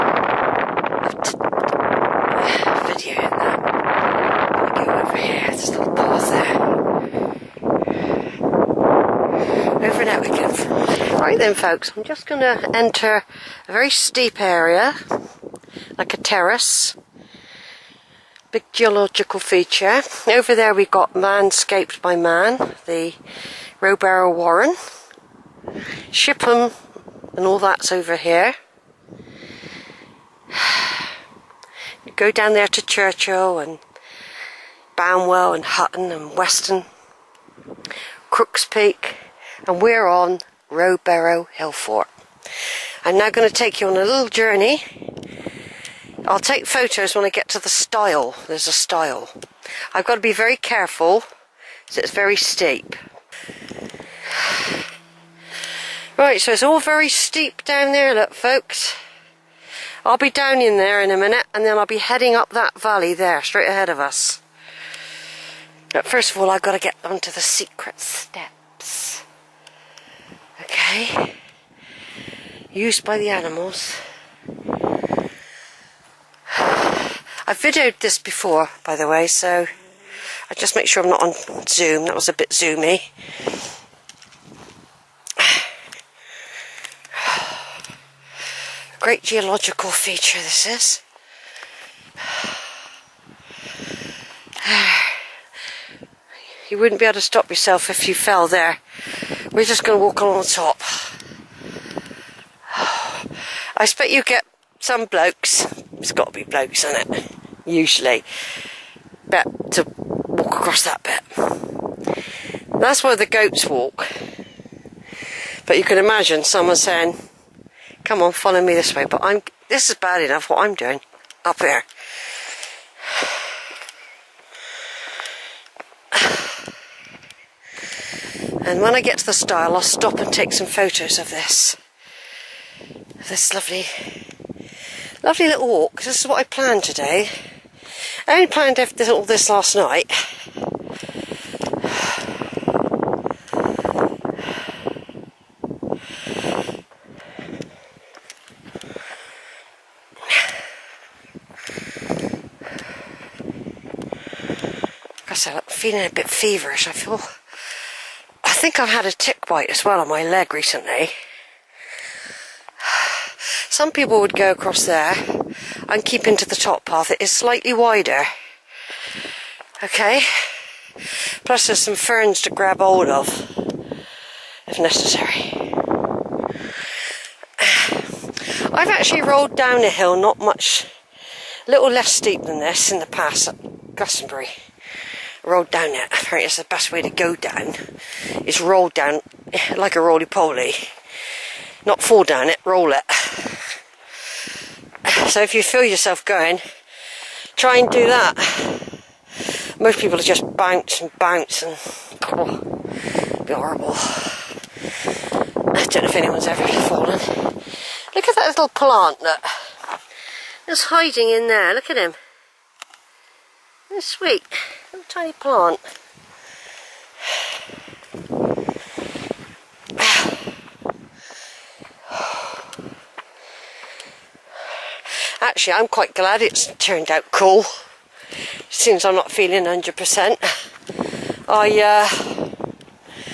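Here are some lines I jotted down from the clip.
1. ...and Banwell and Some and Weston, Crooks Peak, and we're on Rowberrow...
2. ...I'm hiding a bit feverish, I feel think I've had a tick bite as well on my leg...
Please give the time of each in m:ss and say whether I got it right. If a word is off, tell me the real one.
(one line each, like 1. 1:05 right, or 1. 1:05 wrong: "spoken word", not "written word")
1. 0:33 wrong: "Hutton", not "Some"
2. 2:35 wrong: "feeling", not "hiding".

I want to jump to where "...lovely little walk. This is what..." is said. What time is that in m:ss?
2:15.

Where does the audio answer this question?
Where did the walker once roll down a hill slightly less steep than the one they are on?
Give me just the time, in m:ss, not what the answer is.
3:03.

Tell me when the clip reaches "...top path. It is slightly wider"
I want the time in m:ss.
2:46.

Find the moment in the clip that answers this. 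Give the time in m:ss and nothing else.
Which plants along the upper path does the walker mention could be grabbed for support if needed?
2:51.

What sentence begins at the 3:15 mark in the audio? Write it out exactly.
So if you feel yourself going, try and do that.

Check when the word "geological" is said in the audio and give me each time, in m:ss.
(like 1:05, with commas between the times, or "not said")
0:18, 1:29.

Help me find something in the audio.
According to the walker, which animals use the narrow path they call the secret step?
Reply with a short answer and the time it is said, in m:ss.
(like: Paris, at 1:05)
Goats, at 1:53.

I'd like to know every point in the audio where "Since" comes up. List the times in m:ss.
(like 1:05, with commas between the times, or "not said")
3:48.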